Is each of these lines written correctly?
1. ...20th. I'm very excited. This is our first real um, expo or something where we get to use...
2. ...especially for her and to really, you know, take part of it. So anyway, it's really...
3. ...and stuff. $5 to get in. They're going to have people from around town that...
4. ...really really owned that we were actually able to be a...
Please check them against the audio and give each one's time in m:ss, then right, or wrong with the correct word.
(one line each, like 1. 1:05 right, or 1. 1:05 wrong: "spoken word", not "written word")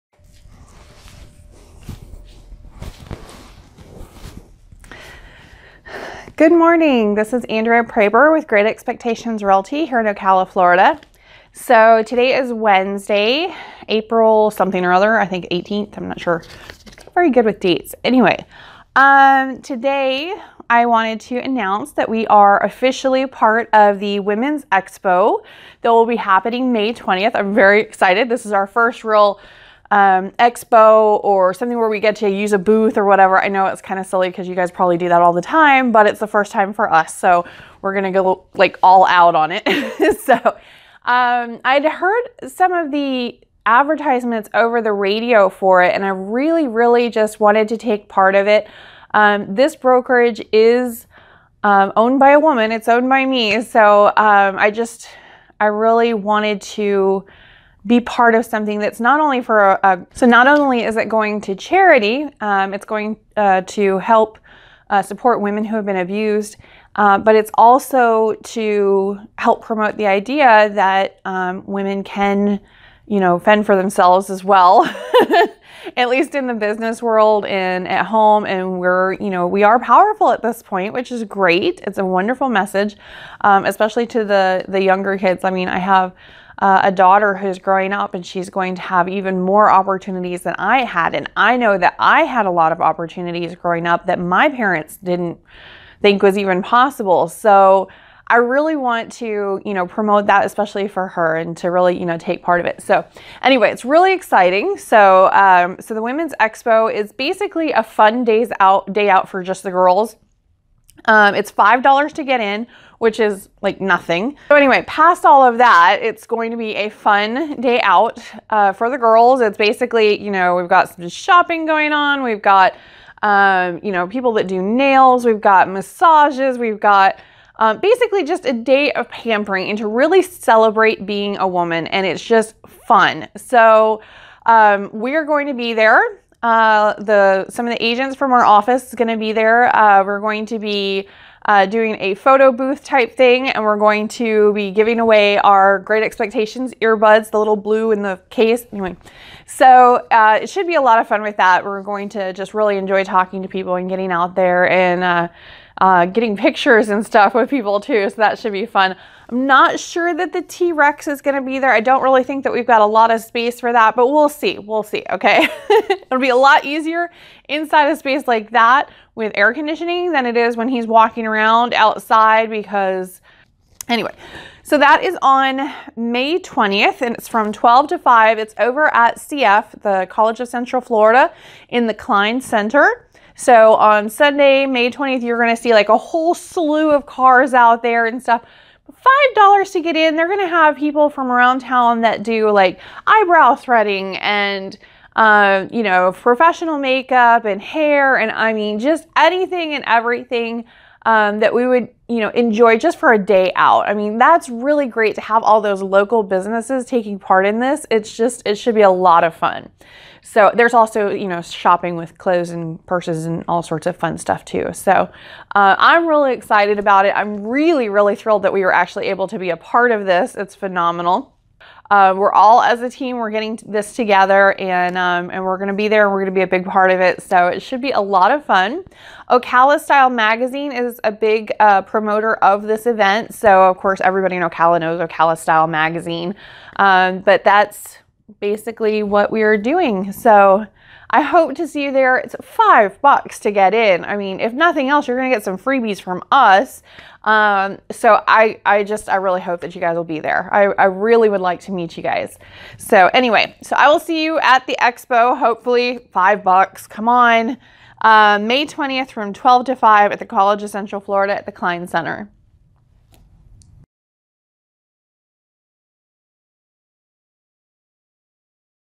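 1. 0:26 right
2. 1:40 right
3. 3:08 right
4. 3:37 wrong: "thrilled", not "owned".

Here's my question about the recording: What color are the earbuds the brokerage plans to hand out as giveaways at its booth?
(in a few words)
Blue.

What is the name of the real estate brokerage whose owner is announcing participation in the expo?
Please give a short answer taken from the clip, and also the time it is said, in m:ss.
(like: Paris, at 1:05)
Great Expectations Realty, at 0:08.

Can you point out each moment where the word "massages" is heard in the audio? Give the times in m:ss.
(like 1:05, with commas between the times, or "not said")
2:05.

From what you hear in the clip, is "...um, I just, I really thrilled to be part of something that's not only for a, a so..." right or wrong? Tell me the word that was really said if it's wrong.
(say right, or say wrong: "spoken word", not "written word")
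wrong: "wanted", not "thrilled".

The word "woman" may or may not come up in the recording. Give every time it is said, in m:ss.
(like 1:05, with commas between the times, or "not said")
0:52, 2:11.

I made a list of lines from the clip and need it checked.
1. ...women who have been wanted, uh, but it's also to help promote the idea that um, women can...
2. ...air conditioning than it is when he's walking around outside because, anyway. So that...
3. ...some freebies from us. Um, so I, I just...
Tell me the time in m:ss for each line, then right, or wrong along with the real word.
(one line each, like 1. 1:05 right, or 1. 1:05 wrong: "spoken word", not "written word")
1. 1:05 wrong: "abused", not "wanted"
2. 2:49 right
3. 4:05 right.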